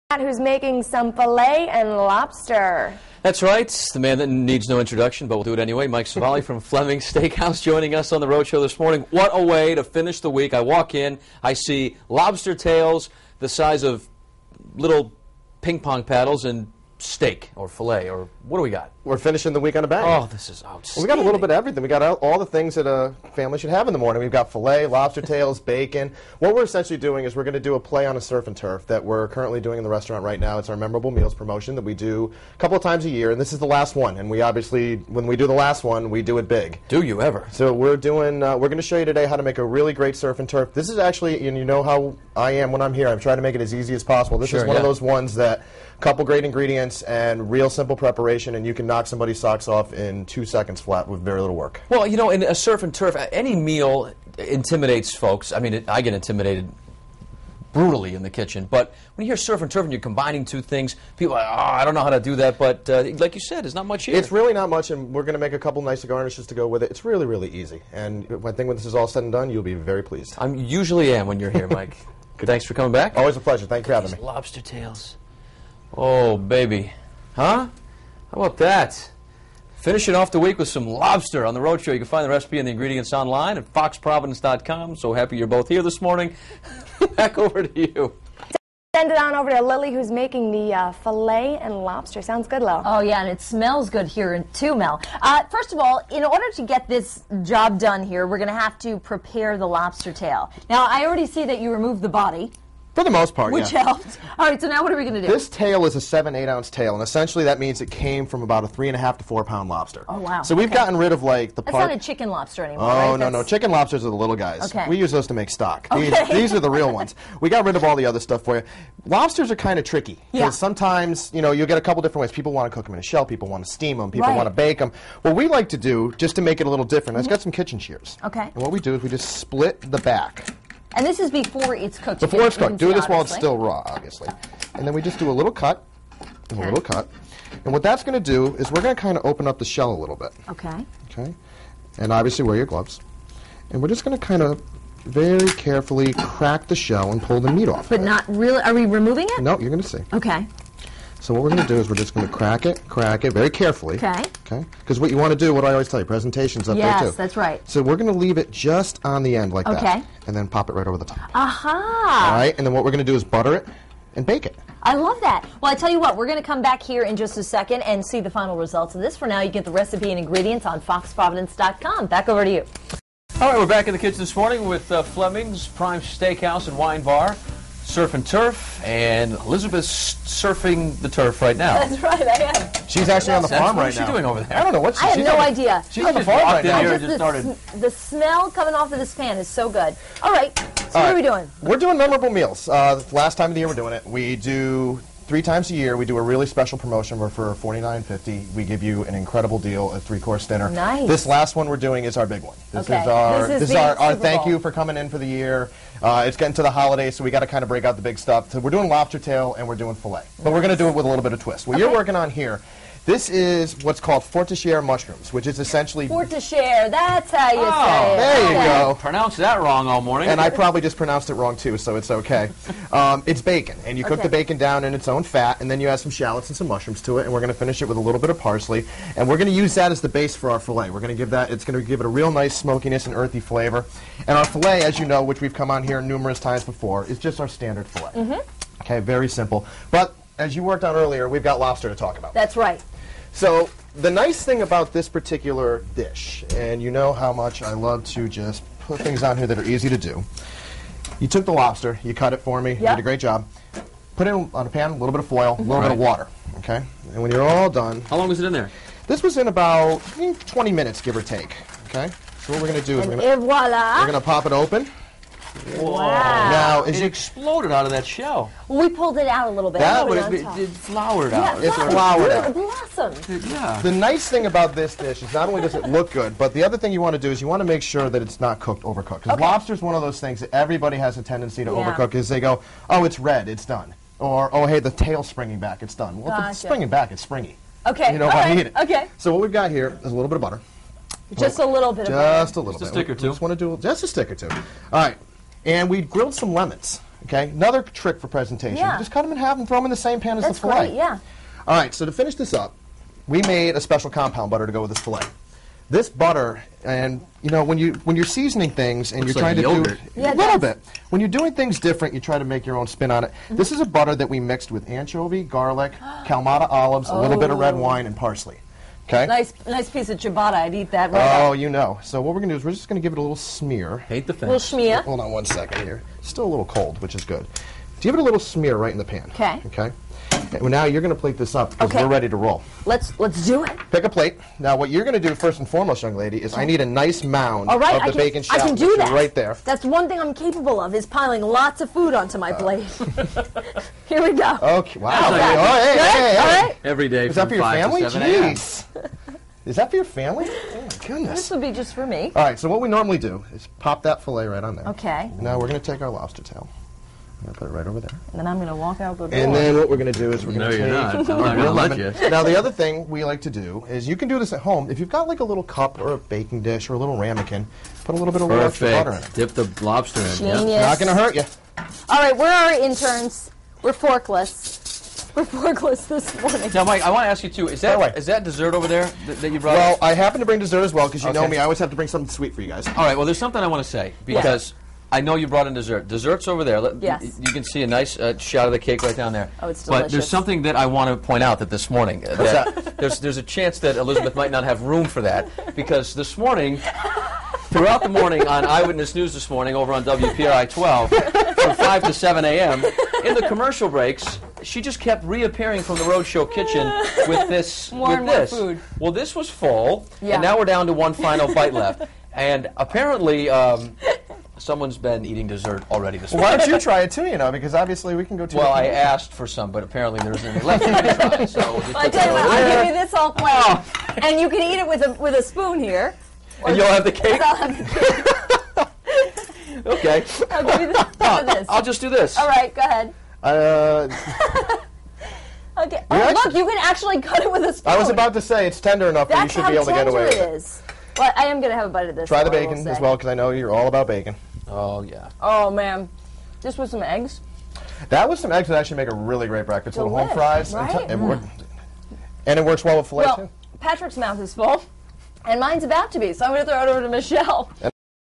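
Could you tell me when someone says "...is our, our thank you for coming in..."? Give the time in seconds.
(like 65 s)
203 s.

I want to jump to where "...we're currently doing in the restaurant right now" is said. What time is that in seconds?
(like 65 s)
29 s.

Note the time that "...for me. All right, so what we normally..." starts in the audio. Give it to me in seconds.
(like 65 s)
351 s.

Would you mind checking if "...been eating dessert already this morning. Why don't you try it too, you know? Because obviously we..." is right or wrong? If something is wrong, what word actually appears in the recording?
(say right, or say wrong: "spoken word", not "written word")
right.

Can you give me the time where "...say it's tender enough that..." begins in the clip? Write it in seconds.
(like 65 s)
438 s.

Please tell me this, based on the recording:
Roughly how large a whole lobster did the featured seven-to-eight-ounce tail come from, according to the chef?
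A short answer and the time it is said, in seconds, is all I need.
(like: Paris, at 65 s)
3.5 to 4 pounds, at 108 s.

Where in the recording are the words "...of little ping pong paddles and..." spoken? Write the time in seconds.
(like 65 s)
13 s.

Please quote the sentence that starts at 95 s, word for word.
Uh, first of all, in order to get this job done here, we're going to have to prepare the lobster tail.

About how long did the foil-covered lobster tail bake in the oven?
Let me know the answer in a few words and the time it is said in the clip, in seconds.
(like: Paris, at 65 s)
20 minutes, at 260 s.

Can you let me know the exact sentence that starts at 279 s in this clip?
lobster is one of those things that everybody has a tendency to yeah.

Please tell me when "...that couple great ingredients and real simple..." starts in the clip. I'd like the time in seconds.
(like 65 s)
45 s.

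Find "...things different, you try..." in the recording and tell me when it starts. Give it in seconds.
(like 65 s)
311 s.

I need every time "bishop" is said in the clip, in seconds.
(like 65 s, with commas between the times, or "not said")
not said.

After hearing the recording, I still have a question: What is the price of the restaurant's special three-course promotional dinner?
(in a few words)
$49.50.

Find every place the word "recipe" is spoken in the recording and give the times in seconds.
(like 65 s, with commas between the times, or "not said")
82 s, 169 s.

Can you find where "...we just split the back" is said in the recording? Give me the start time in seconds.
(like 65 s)
129 s.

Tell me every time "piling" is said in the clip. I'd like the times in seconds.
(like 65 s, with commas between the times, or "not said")
341 s.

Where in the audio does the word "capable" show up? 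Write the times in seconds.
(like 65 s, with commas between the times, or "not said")
340 s.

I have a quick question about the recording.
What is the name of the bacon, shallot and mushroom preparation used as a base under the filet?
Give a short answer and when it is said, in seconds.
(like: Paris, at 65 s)
Forestiere mushrooms, at 214 s.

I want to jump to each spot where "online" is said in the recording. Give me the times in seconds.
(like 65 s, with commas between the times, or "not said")
83 s.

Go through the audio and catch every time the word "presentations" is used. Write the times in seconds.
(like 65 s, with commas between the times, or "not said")
156 s, 298 s.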